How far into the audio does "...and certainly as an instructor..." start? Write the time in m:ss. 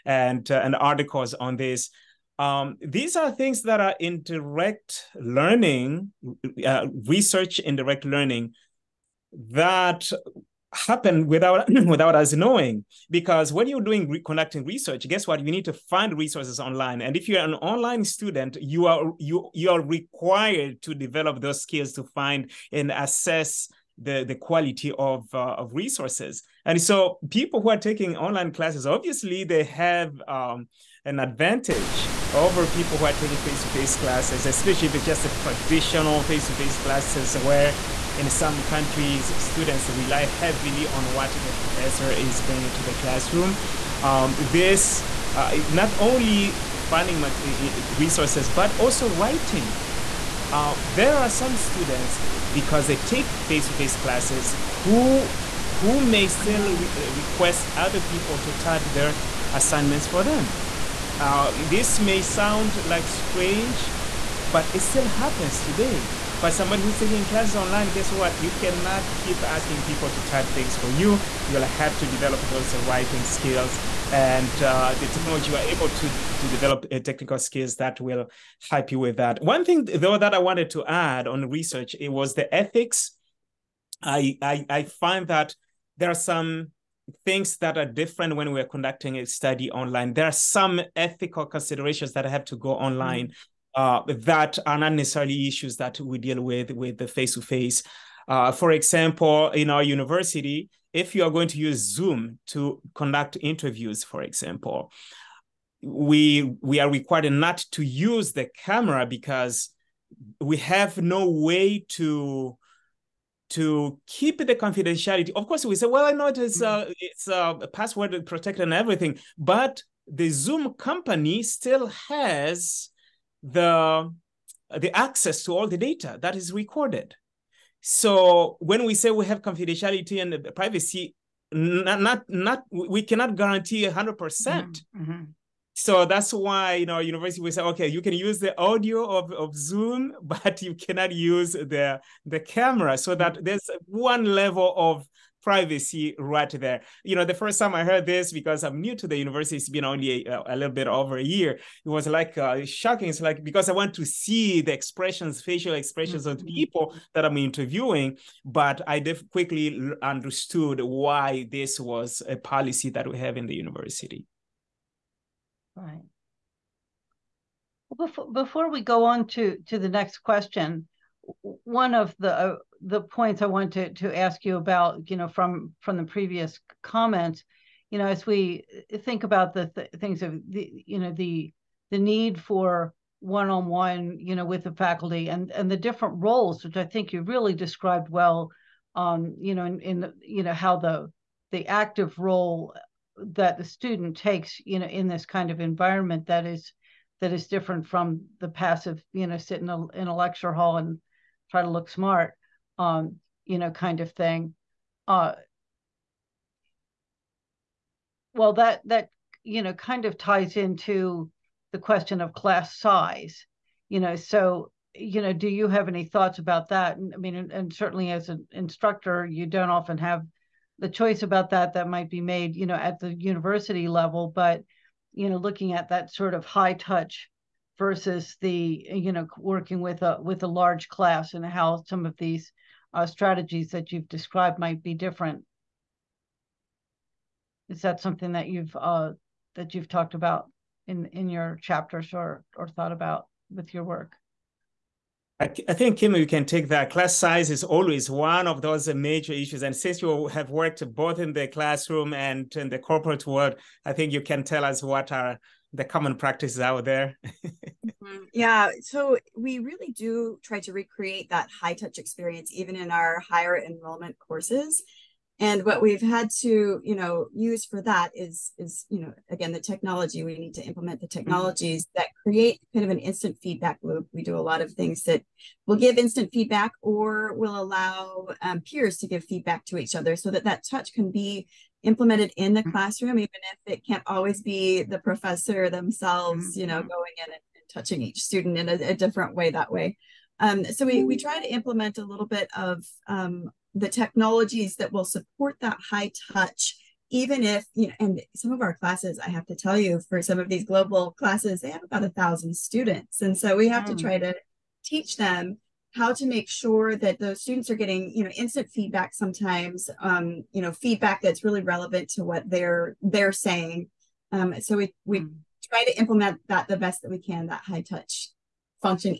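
3:37.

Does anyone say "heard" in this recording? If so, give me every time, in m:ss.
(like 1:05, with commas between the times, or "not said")
2:27.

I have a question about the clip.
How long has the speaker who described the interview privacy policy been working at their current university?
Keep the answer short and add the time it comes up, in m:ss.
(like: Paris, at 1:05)
a little bit over a year, at 2:30.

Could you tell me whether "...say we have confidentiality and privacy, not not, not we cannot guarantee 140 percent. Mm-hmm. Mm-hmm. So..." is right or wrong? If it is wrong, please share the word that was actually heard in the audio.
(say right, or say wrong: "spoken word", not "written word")
wrong: "100", not "140".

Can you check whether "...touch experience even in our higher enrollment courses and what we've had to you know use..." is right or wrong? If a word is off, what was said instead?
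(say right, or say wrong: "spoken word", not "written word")
right.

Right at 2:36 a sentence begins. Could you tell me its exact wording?
of people that I'm interviewing, but I def- quickly understood why this was a policy that we have in the university.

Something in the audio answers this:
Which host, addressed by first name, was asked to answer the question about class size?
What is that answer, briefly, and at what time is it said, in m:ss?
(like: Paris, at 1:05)
Kim, at 4:05.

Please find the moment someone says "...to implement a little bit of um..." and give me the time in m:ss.
4:51.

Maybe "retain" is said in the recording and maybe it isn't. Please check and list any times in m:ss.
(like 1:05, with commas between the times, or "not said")
not said.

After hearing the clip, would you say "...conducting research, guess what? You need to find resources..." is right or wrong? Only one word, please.
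right.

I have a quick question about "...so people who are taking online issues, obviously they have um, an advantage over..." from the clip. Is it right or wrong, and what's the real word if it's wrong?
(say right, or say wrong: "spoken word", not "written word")
wrong: "classes", not "issues".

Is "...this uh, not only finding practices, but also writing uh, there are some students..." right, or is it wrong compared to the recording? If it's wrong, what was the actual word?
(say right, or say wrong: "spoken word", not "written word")
wrong: "resources", not "practices".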